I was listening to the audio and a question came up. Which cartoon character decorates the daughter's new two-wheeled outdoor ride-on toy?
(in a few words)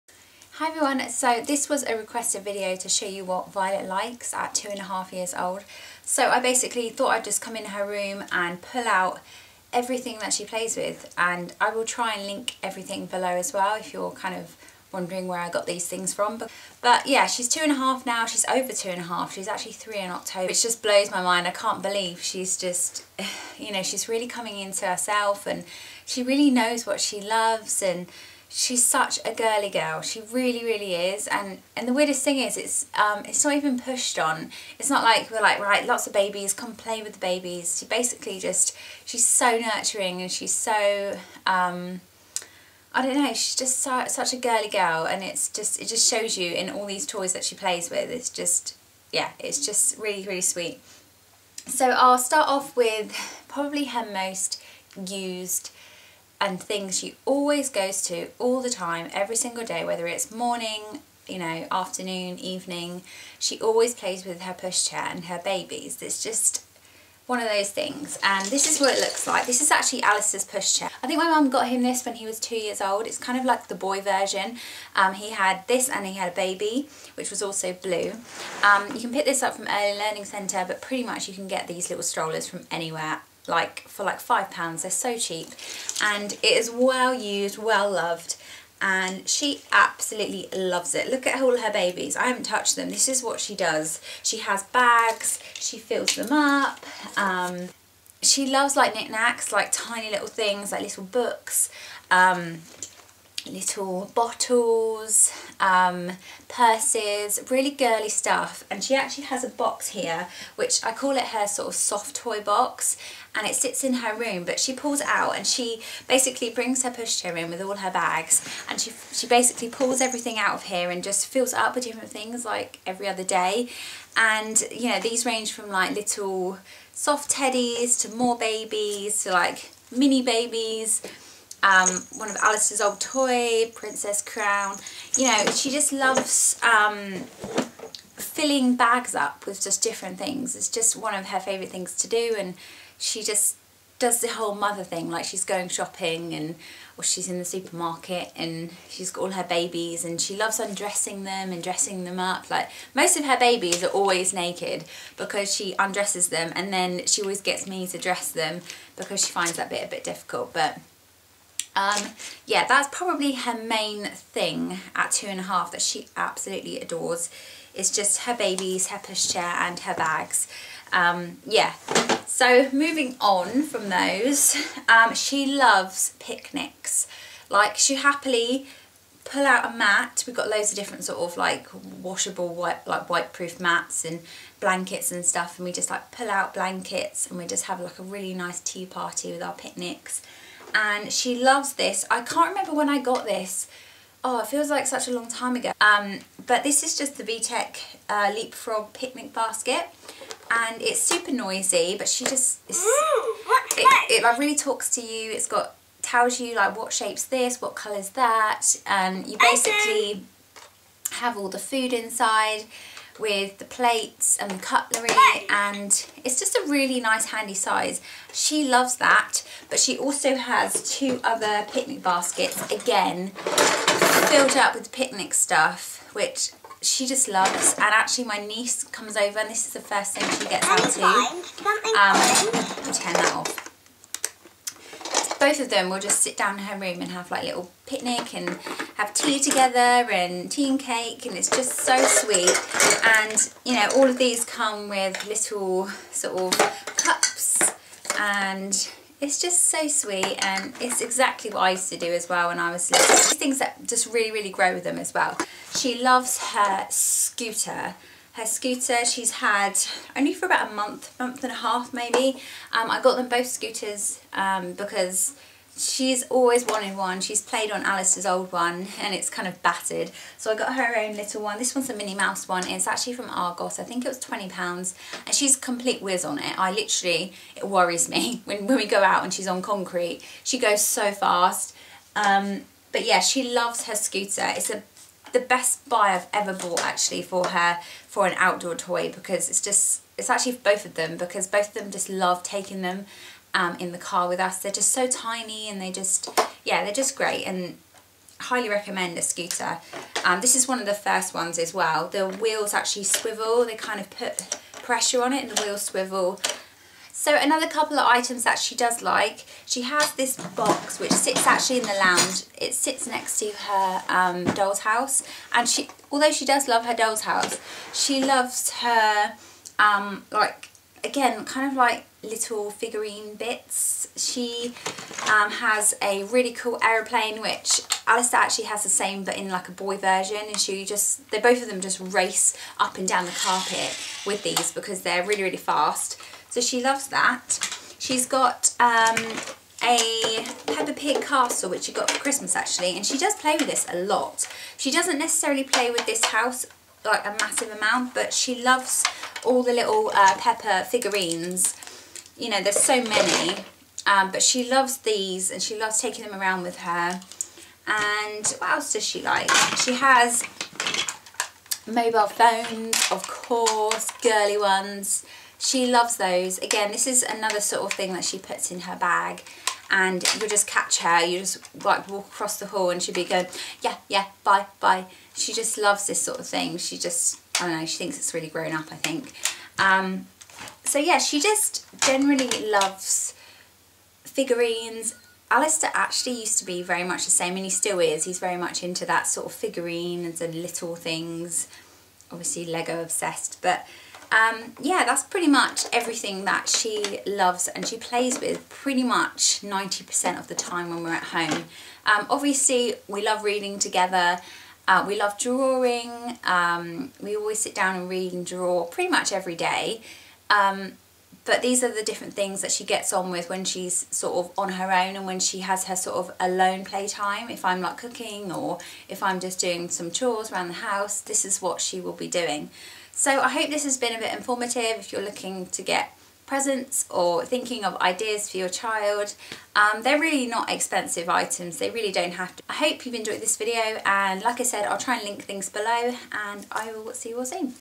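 Minnie Mouse.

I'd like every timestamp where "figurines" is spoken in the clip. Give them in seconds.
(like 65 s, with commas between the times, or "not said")
322 s, 350 s, 384 s, 389 s.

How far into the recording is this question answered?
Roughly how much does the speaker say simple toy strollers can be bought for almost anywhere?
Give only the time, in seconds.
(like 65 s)
84 s.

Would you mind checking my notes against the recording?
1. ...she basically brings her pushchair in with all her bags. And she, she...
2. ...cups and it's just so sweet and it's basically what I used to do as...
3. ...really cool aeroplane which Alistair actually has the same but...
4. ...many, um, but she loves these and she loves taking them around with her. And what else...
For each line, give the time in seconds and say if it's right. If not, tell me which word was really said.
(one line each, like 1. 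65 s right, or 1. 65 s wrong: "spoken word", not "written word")
1. 115 s right
2. 246 s wrong: "exactly", not "basically"
3. 326 s right
4. 353 s right.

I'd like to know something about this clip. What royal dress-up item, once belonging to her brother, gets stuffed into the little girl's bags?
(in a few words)
Princess Crown.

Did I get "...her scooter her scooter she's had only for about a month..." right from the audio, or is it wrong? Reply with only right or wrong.
right.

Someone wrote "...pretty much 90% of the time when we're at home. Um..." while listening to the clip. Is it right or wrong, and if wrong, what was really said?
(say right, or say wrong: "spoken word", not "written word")
right.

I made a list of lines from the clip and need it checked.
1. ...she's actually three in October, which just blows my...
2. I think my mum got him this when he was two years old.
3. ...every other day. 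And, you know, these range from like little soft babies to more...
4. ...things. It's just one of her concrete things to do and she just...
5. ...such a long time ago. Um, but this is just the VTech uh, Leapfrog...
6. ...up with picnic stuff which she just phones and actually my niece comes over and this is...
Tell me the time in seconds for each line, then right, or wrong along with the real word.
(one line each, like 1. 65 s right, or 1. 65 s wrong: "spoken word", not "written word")
1. 19 s right
2. 71 s right
3. 122 s wrong: "teddies", not "babies"
4. 140 s wrong: "favourite", not "concrete"
5. 194 s right
6. 224 s wrong: "loves", not "phones".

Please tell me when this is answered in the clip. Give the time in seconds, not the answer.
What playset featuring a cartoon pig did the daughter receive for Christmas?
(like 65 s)
340 s.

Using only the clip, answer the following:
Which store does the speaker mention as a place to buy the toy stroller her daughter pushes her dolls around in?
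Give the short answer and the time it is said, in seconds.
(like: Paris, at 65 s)
Early Learning Centre, at 79 s.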